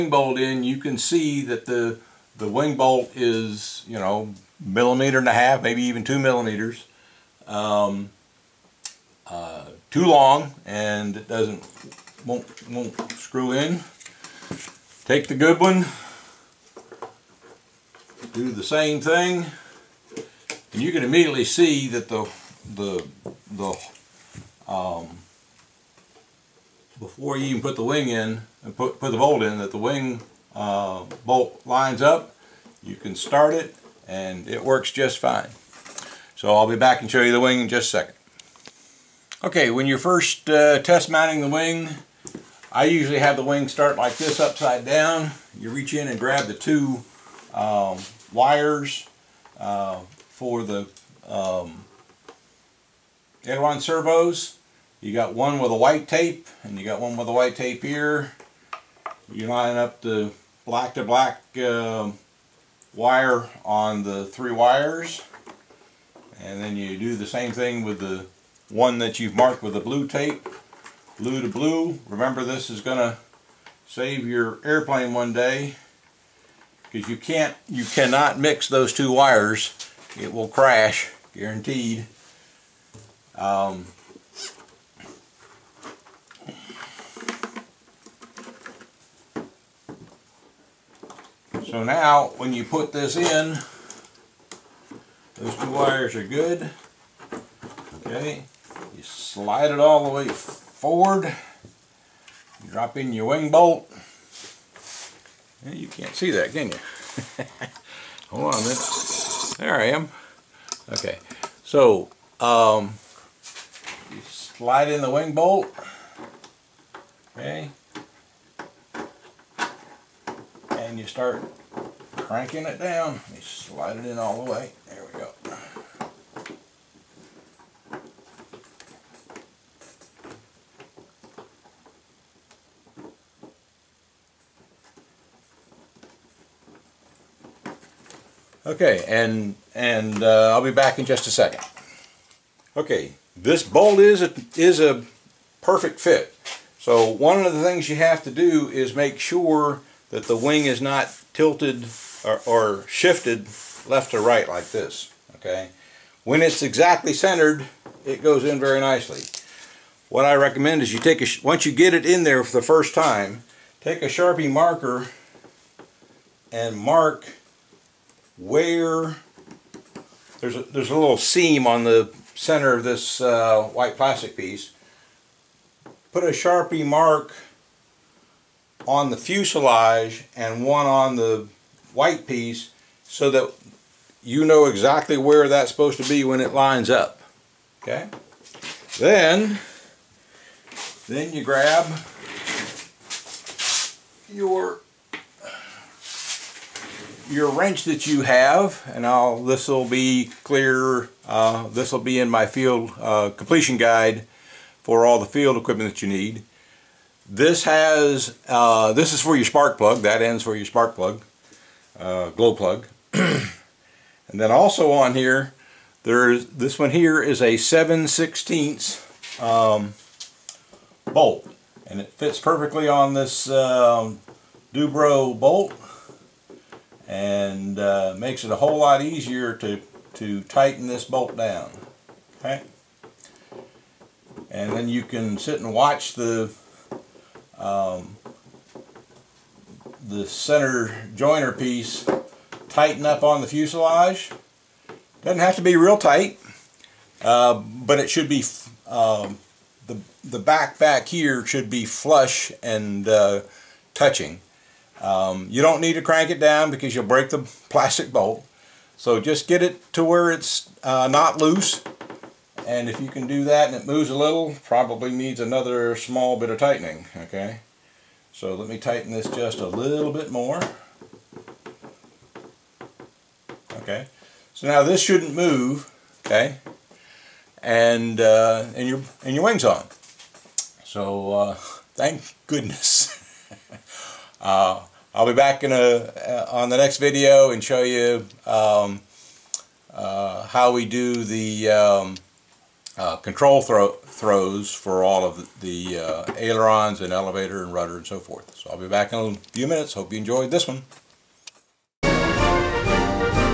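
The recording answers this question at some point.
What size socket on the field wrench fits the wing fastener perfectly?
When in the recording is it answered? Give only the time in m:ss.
3:37.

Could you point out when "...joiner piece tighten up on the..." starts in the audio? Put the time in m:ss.
4:01.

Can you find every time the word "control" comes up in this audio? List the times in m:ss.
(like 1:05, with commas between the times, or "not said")
4:53.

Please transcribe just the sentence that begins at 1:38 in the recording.
Okay, you slide it all the way forward.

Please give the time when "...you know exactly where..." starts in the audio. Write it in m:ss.
3:04.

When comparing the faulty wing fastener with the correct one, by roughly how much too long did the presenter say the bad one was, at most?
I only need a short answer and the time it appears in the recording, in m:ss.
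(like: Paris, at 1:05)
2 millimeters, at 0:06.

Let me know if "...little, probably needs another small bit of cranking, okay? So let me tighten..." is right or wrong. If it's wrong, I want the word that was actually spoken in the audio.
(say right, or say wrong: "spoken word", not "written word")
wrong: "tightening", not "cranking".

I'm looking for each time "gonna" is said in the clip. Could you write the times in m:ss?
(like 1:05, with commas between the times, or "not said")
1:12.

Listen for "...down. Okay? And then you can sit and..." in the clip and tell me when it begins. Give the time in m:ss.
3:51.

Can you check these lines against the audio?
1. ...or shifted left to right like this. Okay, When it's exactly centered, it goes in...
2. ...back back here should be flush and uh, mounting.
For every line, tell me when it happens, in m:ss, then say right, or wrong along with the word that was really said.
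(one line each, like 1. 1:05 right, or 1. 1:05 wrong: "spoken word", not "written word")
1. 2:32 right
2. 4:10 wrong: "touching", not "mounting".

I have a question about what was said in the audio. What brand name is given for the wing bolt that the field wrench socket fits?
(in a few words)
Dubro.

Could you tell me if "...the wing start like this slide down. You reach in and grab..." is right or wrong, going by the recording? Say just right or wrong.
wrong.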